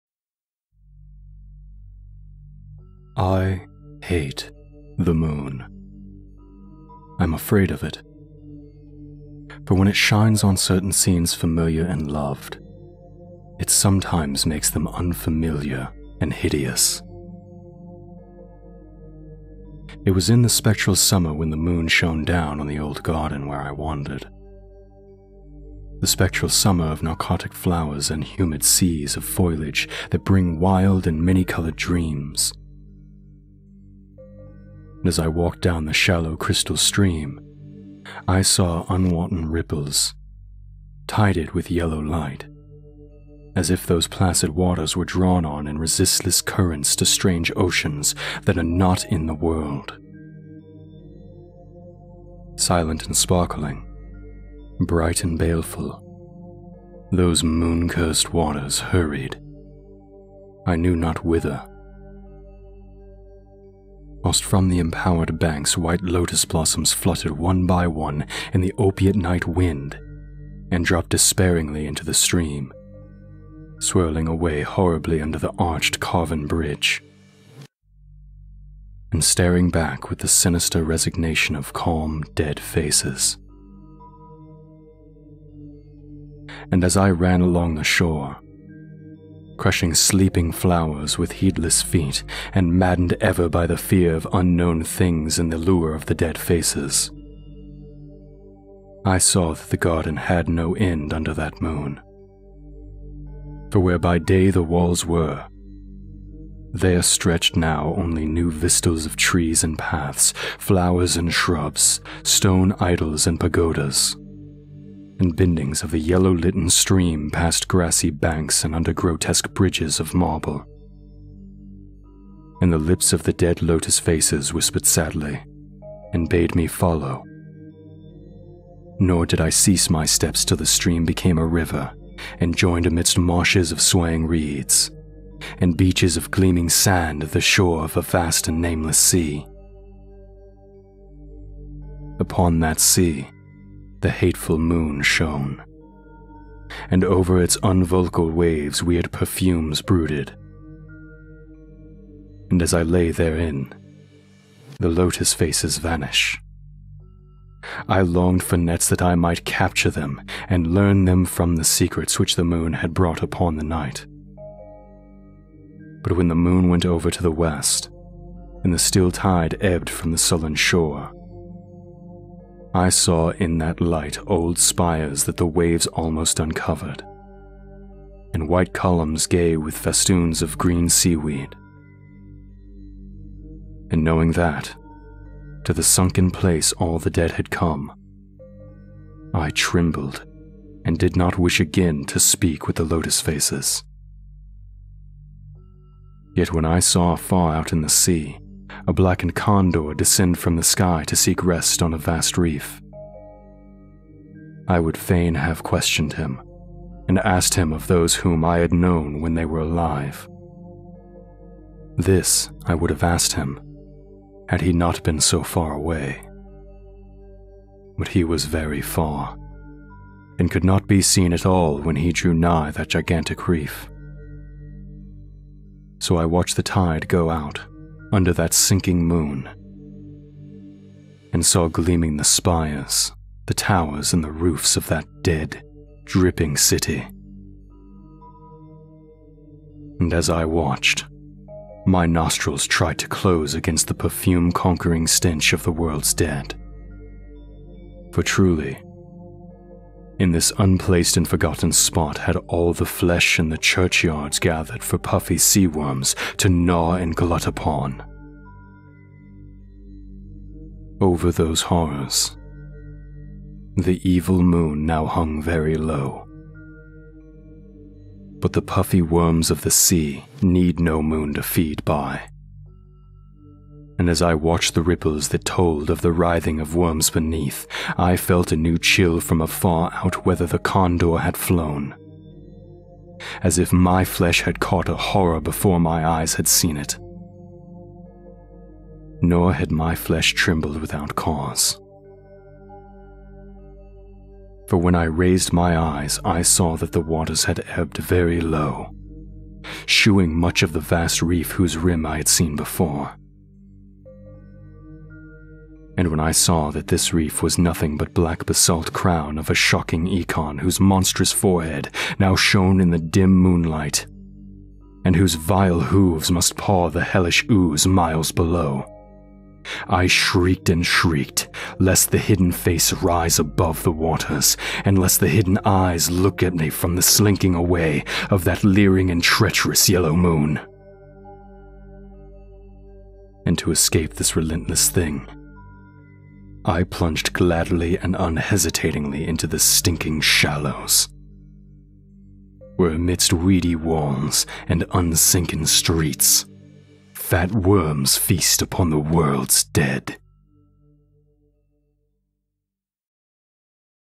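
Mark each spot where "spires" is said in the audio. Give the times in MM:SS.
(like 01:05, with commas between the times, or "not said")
02:54, 03:52.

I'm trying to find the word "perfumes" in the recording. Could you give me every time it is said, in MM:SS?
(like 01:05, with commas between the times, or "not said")
02:29, 04:03.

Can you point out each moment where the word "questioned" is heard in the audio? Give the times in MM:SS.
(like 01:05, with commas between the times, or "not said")
03:25.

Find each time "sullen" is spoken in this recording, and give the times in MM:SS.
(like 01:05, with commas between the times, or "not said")
02:50.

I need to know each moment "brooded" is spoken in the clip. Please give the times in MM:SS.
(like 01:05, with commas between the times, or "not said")
02:29.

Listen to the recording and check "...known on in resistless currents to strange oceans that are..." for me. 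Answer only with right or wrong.
wrong.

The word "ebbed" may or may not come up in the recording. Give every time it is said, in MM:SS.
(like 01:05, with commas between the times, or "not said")
02:49, 04:57.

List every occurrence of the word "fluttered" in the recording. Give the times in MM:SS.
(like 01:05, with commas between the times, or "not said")
01:06.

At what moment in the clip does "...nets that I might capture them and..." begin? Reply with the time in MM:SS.
02:38.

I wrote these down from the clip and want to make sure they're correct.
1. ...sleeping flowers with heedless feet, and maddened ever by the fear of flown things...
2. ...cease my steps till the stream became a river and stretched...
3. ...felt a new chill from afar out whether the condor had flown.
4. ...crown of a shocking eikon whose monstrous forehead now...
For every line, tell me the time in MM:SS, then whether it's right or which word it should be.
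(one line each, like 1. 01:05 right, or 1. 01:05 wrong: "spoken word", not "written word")
1. 01:29 wrong: "unknown", not "flown"
2. 02:09 wrong: "joined", not "stretched"
3. 04:38 right
4. 05:08 right.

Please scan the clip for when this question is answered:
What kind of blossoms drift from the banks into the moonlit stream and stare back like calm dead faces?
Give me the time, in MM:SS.
01:05.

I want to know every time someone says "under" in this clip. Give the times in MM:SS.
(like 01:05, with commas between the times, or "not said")
01:15, 01:41, 01:58, 03:48.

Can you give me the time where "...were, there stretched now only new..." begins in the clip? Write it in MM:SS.
01:45.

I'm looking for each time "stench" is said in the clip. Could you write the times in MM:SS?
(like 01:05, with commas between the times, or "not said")
04:05.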